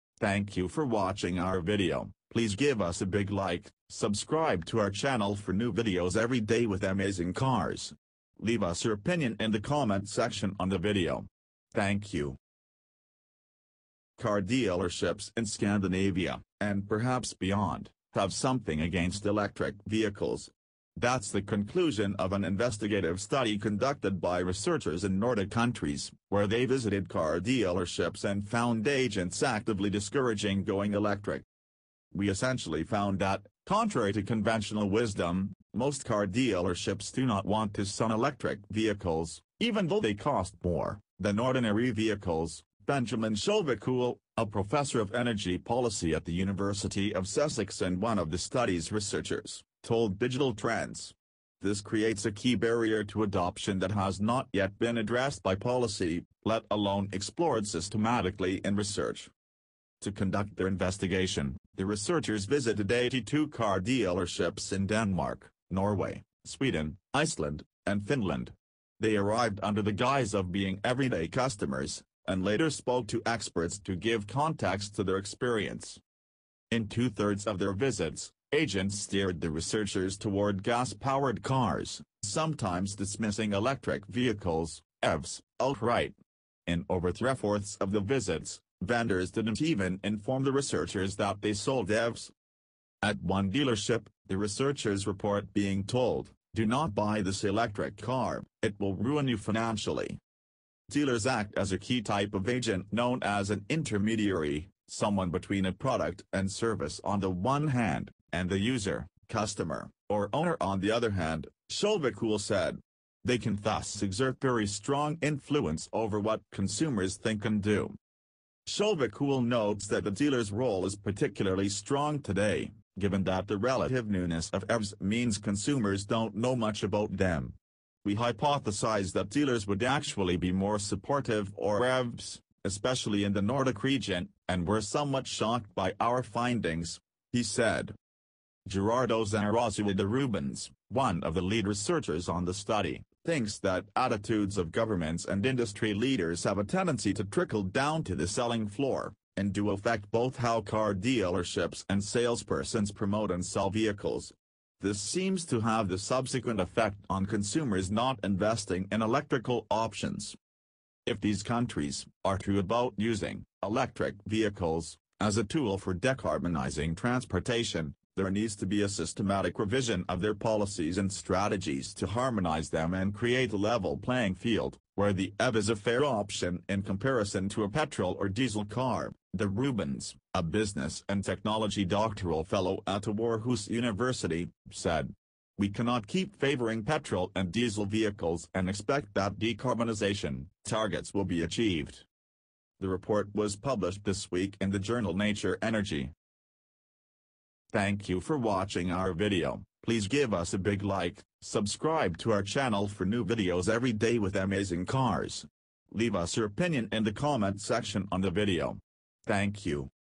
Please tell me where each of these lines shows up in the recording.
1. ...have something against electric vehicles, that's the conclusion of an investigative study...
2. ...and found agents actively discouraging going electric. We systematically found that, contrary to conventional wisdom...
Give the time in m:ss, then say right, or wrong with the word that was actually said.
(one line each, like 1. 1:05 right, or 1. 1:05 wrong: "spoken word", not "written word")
1. 0:18 right
2. 0:28 wrong: "essentially", not "systematically".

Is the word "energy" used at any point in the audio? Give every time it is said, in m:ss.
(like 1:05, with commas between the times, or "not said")
0:45, 3:15.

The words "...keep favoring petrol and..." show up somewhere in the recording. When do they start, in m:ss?
3:06.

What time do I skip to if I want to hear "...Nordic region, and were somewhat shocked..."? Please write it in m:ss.
2:13.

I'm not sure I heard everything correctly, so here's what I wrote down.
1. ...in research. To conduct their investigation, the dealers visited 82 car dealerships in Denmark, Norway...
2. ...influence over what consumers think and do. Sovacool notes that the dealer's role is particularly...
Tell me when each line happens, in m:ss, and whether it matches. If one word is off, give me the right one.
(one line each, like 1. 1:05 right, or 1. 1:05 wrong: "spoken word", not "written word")
1. 0:58 wrong: "researchers", not "dealers"
2. 1:55 right.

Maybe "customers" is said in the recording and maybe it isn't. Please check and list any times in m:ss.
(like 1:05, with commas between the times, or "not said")
1:11, 1:49.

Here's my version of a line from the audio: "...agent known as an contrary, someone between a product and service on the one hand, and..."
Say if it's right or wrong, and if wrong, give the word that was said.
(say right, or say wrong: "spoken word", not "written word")
wrong: "intermediary", not "contrary".